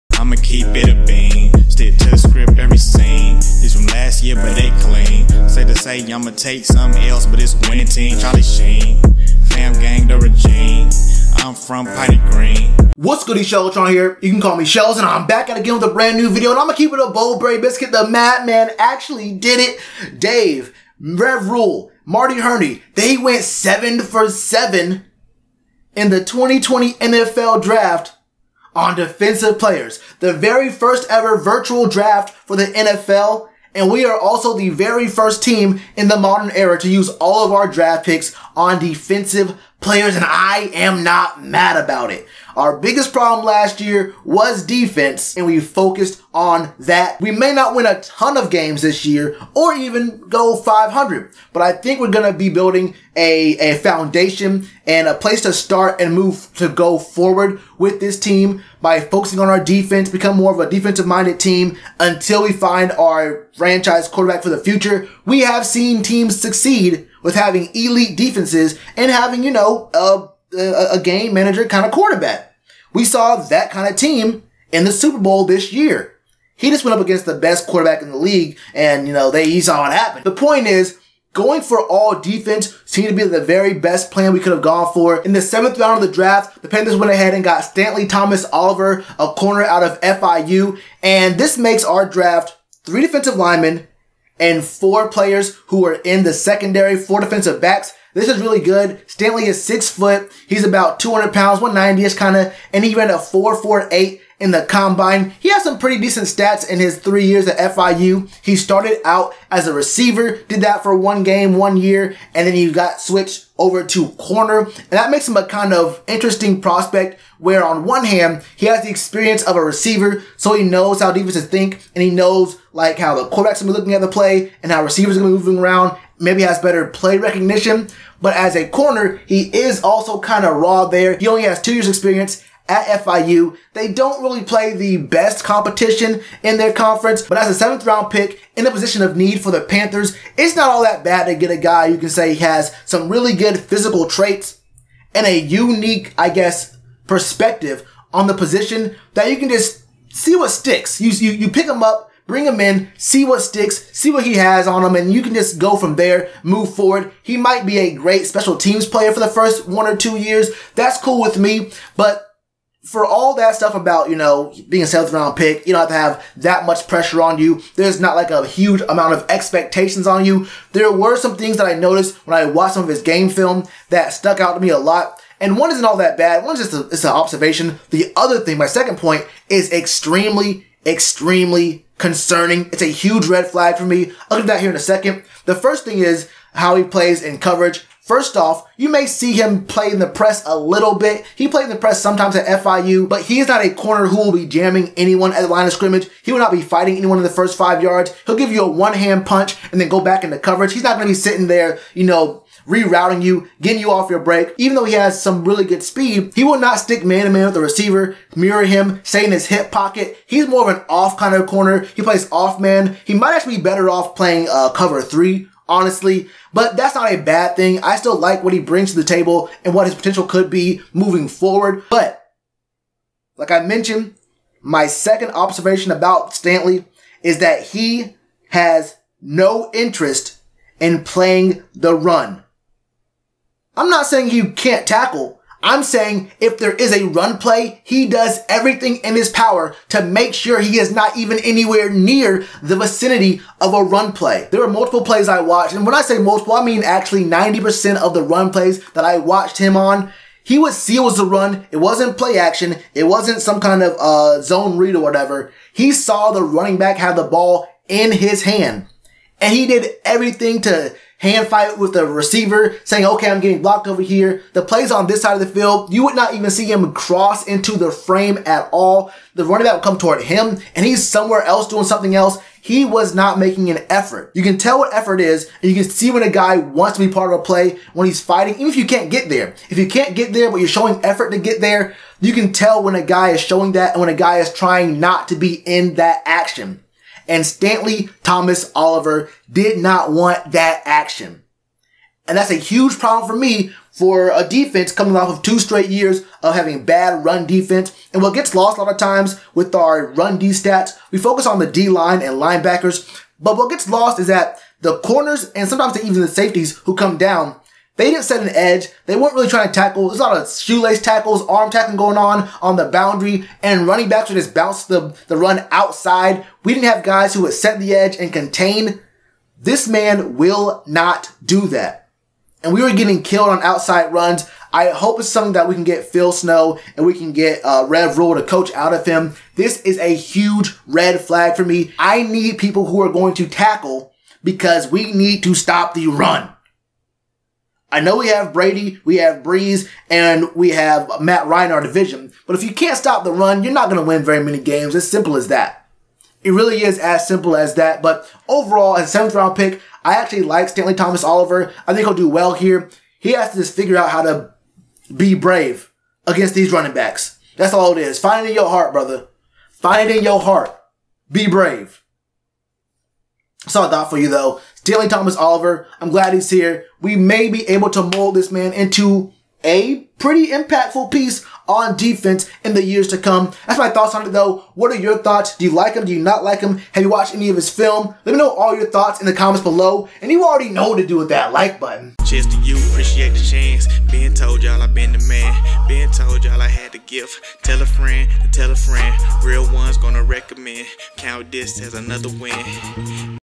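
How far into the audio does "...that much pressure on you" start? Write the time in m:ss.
2:46.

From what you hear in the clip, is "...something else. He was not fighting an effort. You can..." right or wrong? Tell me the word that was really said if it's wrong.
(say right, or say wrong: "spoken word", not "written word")
wrong: "making", not "fighting".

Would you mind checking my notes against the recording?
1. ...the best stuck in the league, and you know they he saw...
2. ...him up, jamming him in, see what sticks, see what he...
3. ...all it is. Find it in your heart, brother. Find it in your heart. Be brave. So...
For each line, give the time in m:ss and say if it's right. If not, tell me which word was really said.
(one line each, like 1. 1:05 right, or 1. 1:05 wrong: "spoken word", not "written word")
1. 1:17 wrong: "quarterback", not "stuck"
2. 2:31 wrong: "bring", not "jamming"
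3. 5:57 right.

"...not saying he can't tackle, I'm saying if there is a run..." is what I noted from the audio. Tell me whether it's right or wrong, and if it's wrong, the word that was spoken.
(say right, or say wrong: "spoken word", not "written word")
right.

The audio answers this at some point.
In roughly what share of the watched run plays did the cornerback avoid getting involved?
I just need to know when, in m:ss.
4:07.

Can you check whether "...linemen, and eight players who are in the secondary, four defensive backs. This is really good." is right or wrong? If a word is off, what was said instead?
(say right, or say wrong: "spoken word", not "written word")
wrong: "four", not "eight".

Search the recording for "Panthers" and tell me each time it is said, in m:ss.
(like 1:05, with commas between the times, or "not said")
1:26, 2:19.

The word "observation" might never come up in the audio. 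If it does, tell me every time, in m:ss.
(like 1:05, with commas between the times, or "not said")
2:57, 3:45.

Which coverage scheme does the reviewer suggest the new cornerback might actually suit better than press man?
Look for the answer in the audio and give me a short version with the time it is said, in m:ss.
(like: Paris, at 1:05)
Cover three, at 3:34.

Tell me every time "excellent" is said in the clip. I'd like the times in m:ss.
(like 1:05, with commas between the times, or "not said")
not said.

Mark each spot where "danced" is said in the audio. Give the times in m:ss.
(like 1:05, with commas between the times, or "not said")
not said.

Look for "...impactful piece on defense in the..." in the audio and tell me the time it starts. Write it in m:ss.
6:10.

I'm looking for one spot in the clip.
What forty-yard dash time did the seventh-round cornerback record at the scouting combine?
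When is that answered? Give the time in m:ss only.
1:43.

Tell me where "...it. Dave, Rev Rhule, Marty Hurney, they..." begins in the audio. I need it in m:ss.
0:19.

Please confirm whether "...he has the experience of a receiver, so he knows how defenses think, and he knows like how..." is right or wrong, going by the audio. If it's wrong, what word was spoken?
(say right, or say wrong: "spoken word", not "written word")
right.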